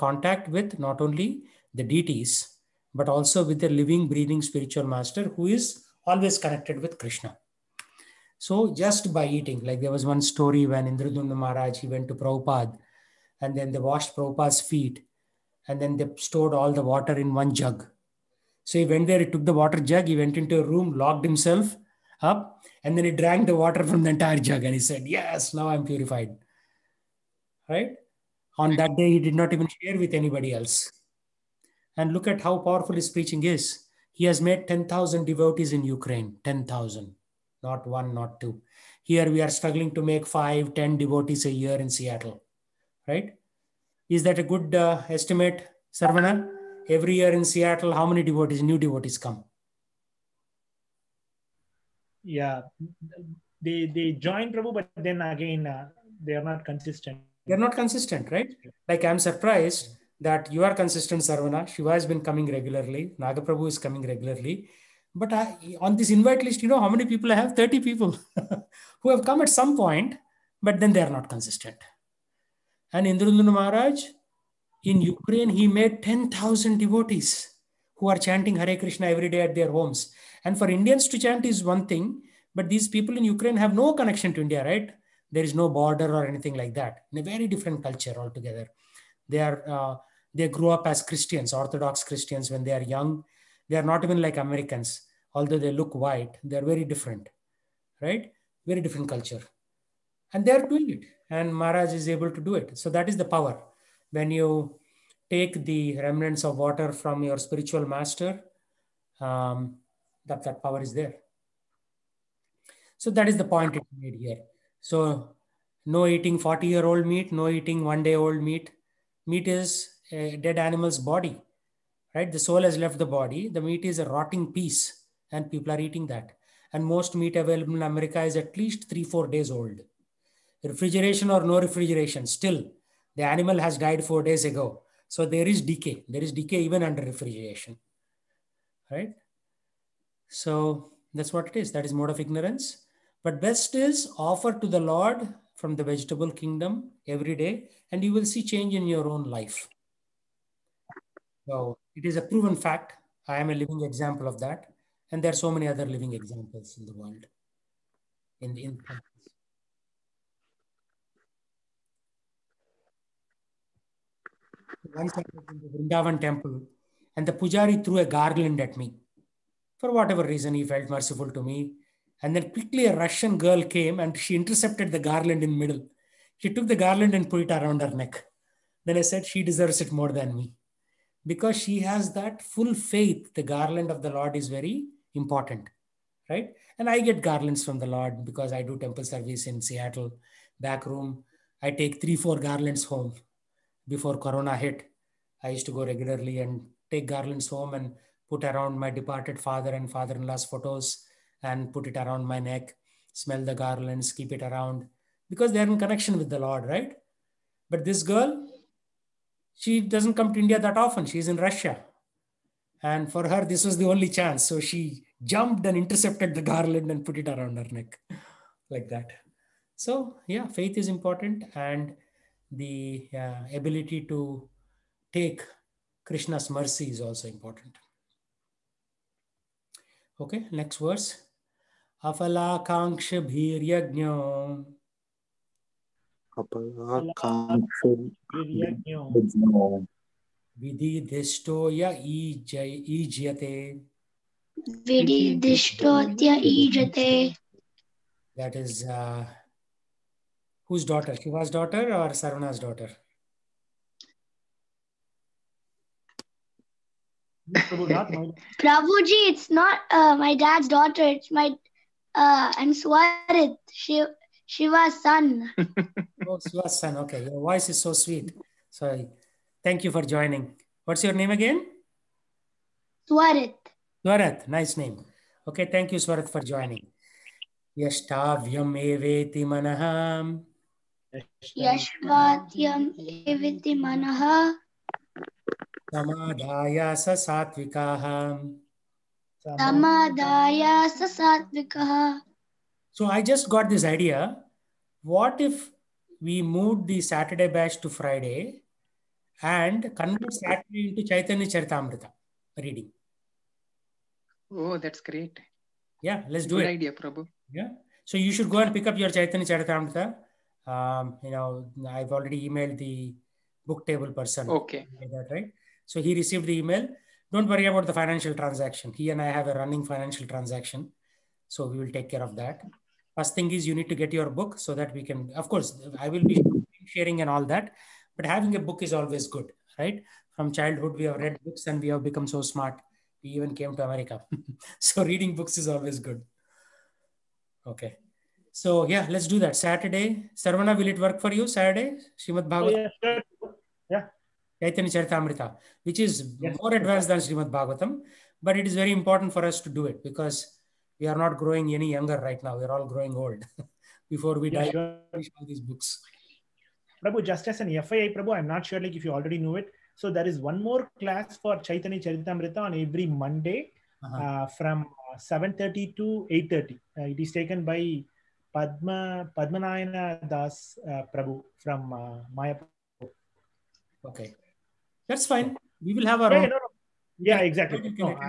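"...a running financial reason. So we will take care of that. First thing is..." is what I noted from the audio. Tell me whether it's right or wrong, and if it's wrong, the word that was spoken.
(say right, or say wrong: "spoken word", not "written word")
wrong: "transaction", not "reason".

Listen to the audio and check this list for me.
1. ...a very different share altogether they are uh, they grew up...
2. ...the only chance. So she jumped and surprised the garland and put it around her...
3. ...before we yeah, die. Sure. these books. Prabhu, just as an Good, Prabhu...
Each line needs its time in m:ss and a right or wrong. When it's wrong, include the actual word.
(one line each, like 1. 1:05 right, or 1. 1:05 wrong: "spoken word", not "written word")
1. 1:27 wrong: "culture", not "share"
2. 3:33 wrong: "intercepted", not "surprised"
3. 5:54 wrong: "FYI", not "Good".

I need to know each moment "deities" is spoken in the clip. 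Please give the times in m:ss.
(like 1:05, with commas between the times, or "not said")
0:01.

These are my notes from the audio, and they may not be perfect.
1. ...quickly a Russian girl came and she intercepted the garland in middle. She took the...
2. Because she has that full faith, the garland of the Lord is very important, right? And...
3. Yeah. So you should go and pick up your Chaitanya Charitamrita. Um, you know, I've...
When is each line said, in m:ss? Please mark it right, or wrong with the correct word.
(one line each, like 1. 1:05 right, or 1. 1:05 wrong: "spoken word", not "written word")
1. 2:52 right
2. 3:01 right
3. 5:07 right.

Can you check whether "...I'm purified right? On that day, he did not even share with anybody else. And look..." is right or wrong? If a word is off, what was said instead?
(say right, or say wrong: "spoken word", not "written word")
right.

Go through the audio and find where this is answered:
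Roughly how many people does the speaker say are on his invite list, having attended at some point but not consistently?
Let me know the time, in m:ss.
1:07.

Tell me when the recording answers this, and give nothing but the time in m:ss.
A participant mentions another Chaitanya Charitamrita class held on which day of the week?
6:03.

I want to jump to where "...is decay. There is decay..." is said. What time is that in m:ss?
2:15.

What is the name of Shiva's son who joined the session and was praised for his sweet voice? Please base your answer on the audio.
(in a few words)
Swarit.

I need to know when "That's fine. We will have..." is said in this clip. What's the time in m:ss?
6:15.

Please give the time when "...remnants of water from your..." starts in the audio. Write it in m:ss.
1:46.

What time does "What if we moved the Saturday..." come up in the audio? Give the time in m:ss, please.
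4:55.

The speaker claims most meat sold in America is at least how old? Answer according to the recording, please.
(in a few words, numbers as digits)
three, four days.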